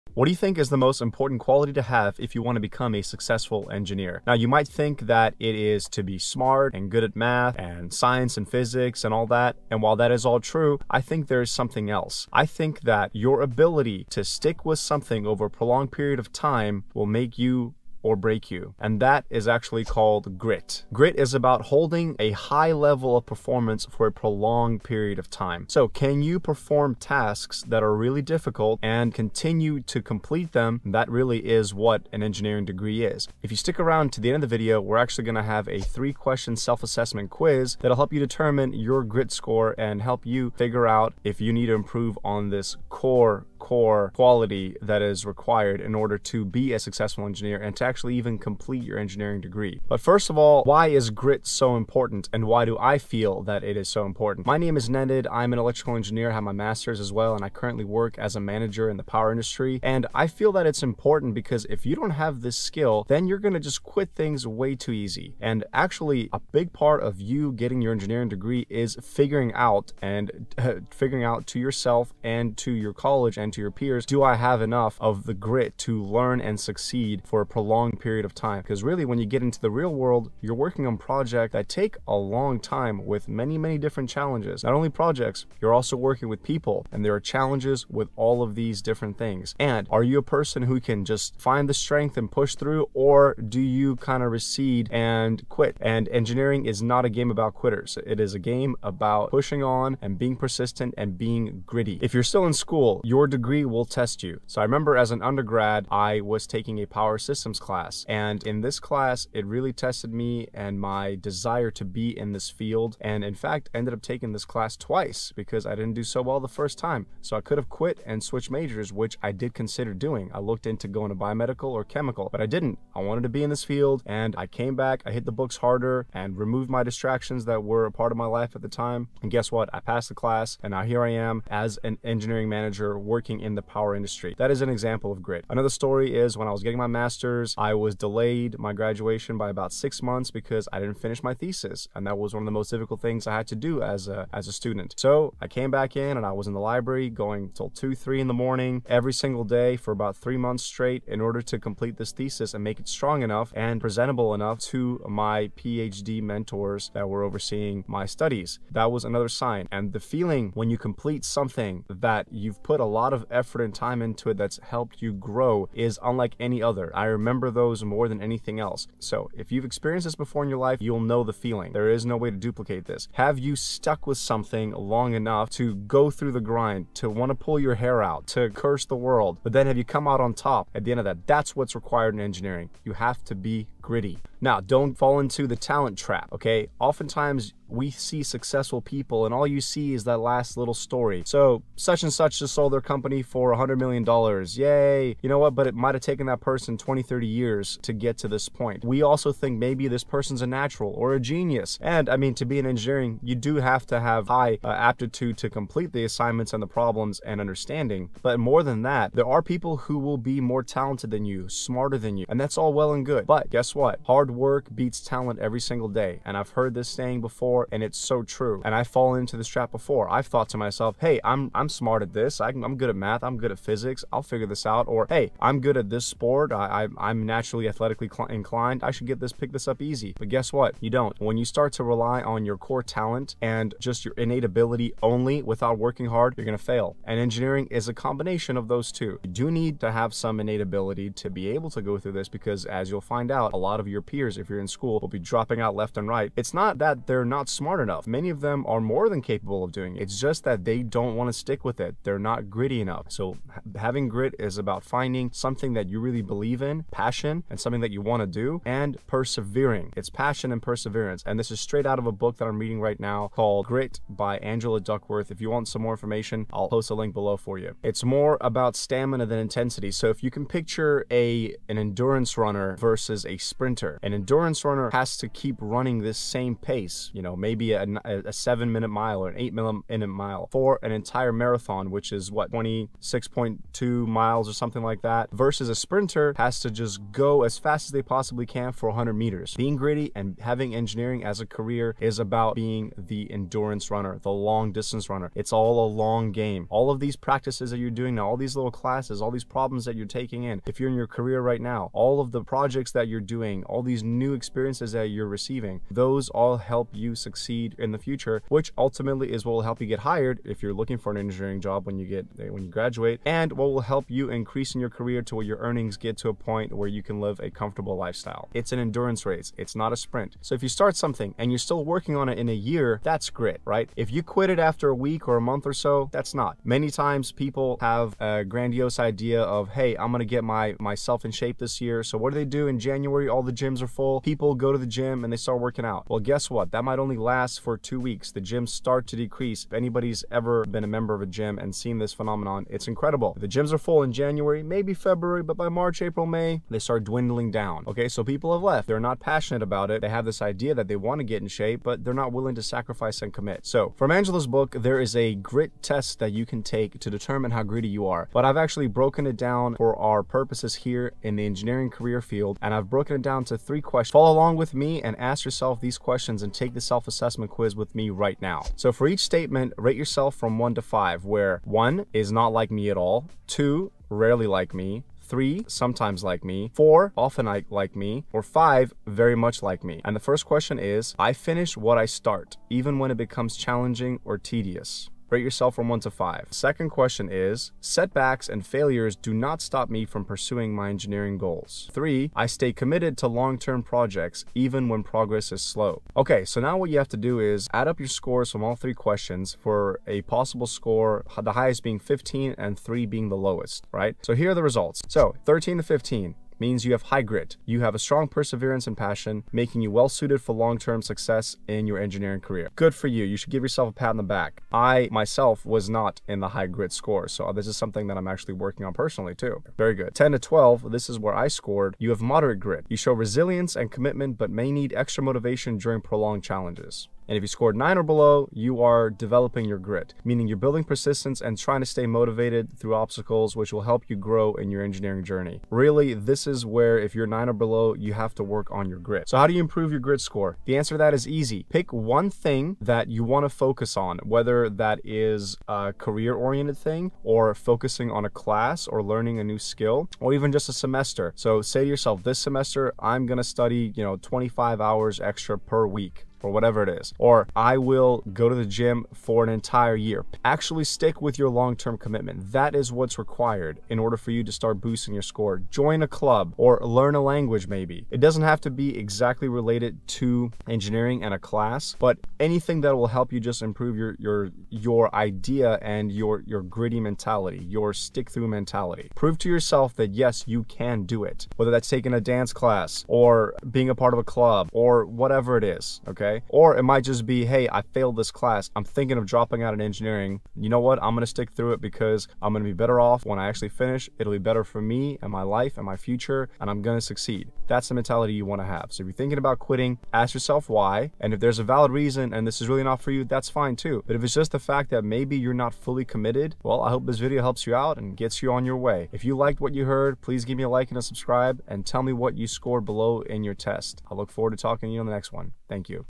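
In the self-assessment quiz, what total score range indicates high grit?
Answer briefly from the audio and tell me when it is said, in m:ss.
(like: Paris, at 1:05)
13 to 15, at 6:45.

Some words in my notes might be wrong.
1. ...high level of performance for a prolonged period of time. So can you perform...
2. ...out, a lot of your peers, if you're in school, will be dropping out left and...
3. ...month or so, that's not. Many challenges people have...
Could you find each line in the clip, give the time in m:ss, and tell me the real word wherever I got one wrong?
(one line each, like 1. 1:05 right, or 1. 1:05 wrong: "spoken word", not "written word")
1. 0:22 right
2. 4:03 right
3. 5:25 wrong: "times", not "challenges".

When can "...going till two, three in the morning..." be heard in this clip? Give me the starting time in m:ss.
2:27.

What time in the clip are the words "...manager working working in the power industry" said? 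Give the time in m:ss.
2:12.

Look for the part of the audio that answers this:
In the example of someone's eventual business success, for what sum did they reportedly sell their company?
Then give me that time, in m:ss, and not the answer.
3:13.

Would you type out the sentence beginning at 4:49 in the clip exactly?
Being gritty and having engineering as a career is about being the endurance runner, the long distance runner.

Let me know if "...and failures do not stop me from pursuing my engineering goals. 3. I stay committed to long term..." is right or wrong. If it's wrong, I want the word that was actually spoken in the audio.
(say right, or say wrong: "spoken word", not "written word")
right.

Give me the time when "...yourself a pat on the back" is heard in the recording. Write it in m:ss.
6:53.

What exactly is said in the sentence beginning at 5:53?
So from Angela's book, there is a grit test that you can take to determine how greedy you are.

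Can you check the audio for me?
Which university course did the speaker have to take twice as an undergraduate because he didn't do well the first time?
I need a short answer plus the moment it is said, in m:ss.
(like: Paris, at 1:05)
Power systems, at 1:46.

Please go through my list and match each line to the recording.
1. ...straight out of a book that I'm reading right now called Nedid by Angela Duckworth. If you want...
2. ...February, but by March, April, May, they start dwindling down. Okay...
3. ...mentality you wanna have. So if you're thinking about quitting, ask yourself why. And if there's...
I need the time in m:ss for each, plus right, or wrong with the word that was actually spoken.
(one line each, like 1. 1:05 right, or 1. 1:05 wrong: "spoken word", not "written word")
1. 4:21 wrong: "Grit", not "Nedid"
2. 5:44 right
3. 8:17 right.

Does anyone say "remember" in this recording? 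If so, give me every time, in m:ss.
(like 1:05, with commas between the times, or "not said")
1:44, 2:47.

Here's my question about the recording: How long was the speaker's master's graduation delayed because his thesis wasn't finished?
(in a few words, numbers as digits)
6.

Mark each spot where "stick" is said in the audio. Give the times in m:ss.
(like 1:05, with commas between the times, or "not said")
0:14, 0:33, 4:11, 7:40, 7:57, 8:11.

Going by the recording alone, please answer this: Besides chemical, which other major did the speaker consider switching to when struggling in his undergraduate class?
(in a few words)
Biomedical.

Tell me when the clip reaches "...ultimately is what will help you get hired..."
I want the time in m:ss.
5:08.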